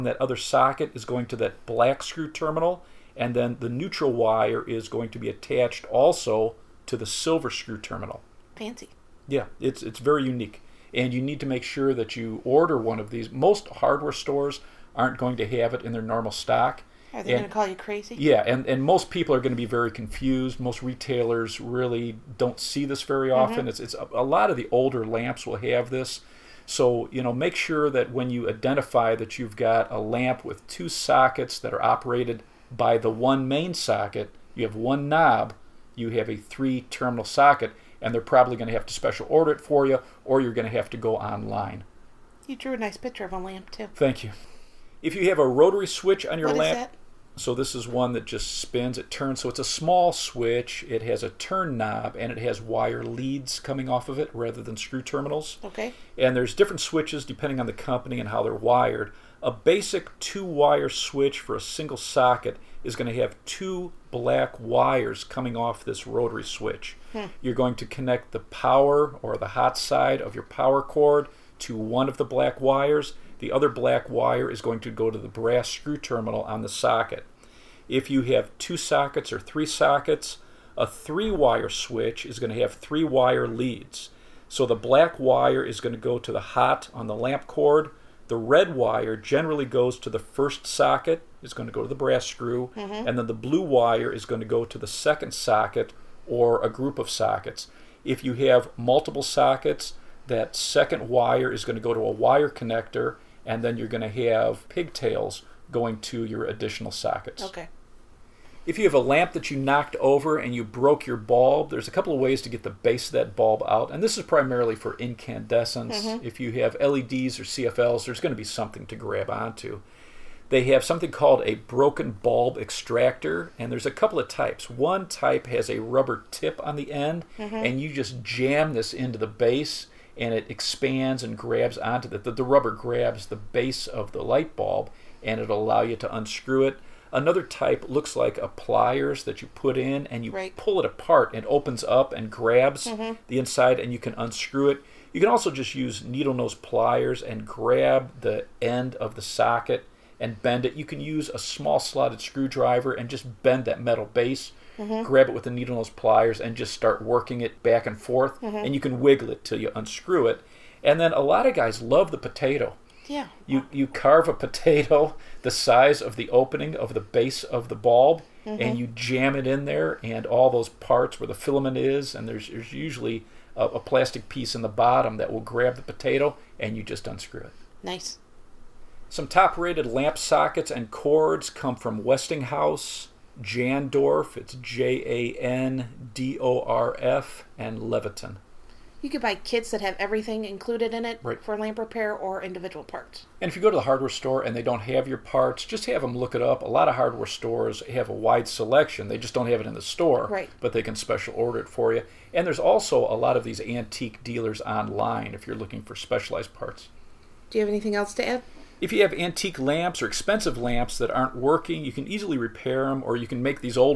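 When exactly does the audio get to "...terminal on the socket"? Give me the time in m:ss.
1:15.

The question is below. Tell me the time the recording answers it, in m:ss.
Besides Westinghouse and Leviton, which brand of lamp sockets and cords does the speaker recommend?
3:03.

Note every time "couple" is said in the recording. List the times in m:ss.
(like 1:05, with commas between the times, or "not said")
1:51, 2:03.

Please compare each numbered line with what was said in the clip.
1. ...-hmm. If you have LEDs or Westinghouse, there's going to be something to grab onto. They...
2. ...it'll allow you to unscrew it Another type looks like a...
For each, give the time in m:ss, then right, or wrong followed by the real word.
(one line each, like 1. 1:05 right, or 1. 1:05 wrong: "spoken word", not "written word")
1. 1:56 wrong: "CFLs", not "Westinghouse"
2. 2:15 right.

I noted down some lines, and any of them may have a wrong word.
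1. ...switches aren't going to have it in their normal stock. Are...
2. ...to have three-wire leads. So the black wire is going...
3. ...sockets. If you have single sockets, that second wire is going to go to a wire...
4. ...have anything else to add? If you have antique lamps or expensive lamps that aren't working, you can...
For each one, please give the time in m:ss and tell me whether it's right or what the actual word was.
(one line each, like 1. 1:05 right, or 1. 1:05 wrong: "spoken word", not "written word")
1. 0:14 wrong: "stores", not "switches"
2. 1:22 right
3. 1:37 wrong: "multiple", not "single"
4. 3:27 right.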